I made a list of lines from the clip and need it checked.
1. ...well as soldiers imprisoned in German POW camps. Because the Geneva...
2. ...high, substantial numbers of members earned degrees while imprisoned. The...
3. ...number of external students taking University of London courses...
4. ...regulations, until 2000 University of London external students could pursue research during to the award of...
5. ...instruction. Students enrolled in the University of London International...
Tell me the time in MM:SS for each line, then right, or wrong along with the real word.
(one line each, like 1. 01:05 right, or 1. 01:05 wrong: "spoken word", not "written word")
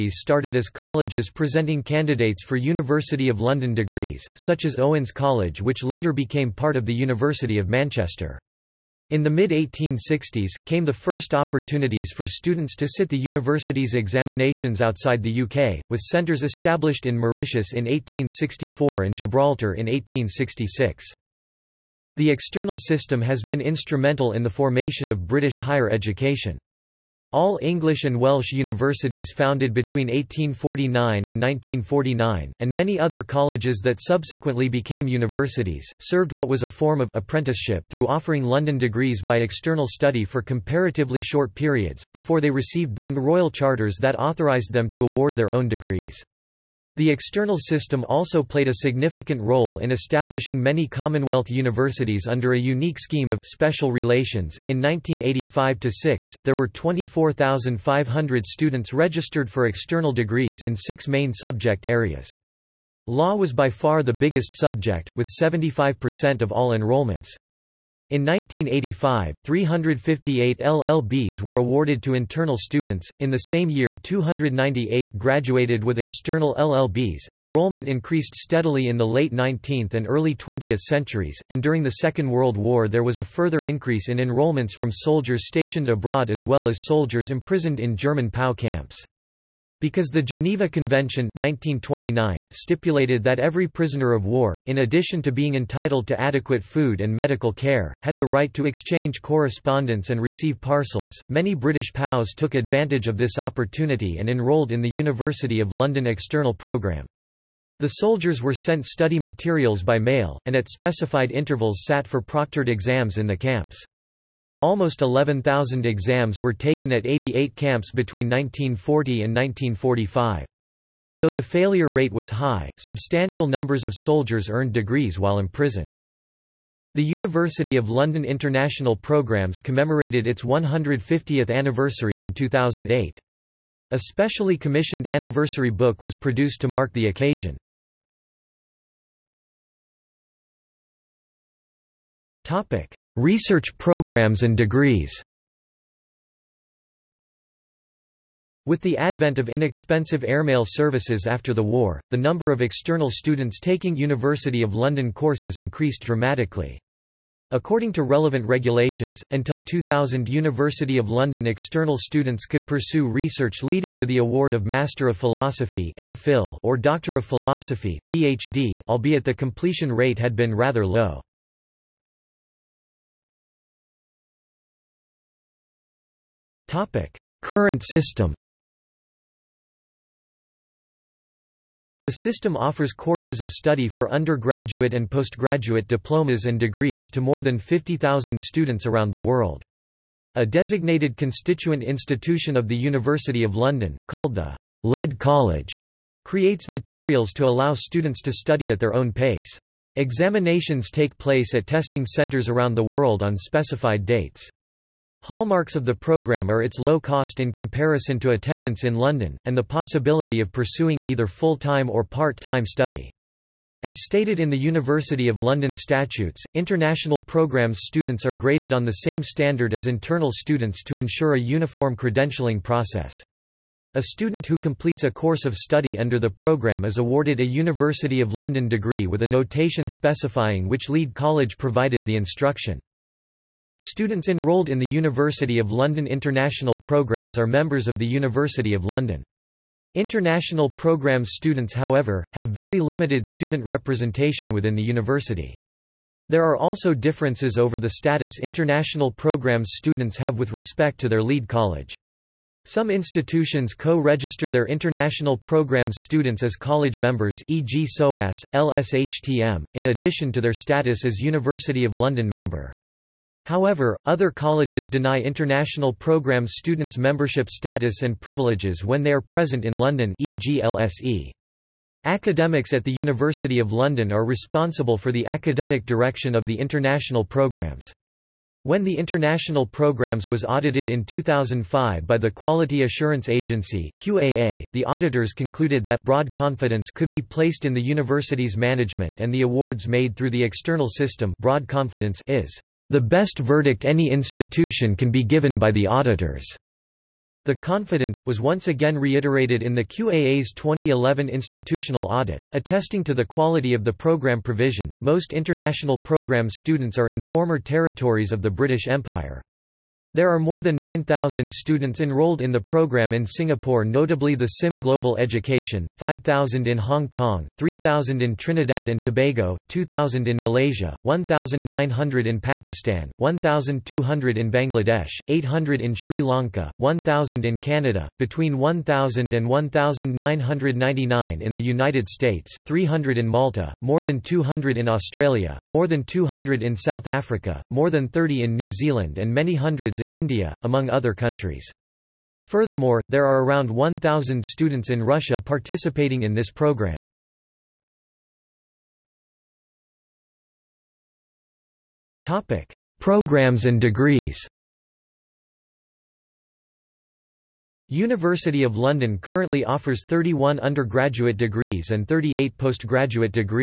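1. 01:26 right
2. 02:02 wrong: "soldiers", not "members"
3. 02:32 right
4. 02:38 wrong: "leading", not "during"
5. 03:52 right.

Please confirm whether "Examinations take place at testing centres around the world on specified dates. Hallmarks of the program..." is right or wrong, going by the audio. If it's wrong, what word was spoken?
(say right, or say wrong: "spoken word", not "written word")
right.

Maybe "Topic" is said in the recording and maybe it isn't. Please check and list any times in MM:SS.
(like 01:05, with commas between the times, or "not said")
02:22, 05:52.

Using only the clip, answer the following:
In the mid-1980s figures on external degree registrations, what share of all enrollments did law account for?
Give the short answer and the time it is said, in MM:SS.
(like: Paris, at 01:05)
75%, at 01:05.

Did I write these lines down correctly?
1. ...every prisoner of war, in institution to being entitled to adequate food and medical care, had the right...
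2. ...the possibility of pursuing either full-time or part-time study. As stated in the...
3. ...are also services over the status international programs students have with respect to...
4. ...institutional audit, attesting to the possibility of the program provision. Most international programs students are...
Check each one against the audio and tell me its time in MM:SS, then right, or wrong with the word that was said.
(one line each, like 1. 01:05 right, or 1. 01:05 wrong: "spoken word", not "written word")
1. 01:33 wrong: "addition", not "institution"
2. 03:29 right
3. 04:06 wrong: "differences", not "services"
4. 05:01 wrong: "quality", not "possibility".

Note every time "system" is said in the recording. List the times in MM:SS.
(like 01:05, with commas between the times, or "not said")
00:22, 00:47, 02:57, 03:02, 04:50.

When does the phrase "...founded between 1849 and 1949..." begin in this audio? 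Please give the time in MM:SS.
00:29.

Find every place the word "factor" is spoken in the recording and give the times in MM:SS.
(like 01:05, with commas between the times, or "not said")
not said.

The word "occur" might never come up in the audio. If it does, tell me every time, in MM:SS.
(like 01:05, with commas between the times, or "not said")
not said.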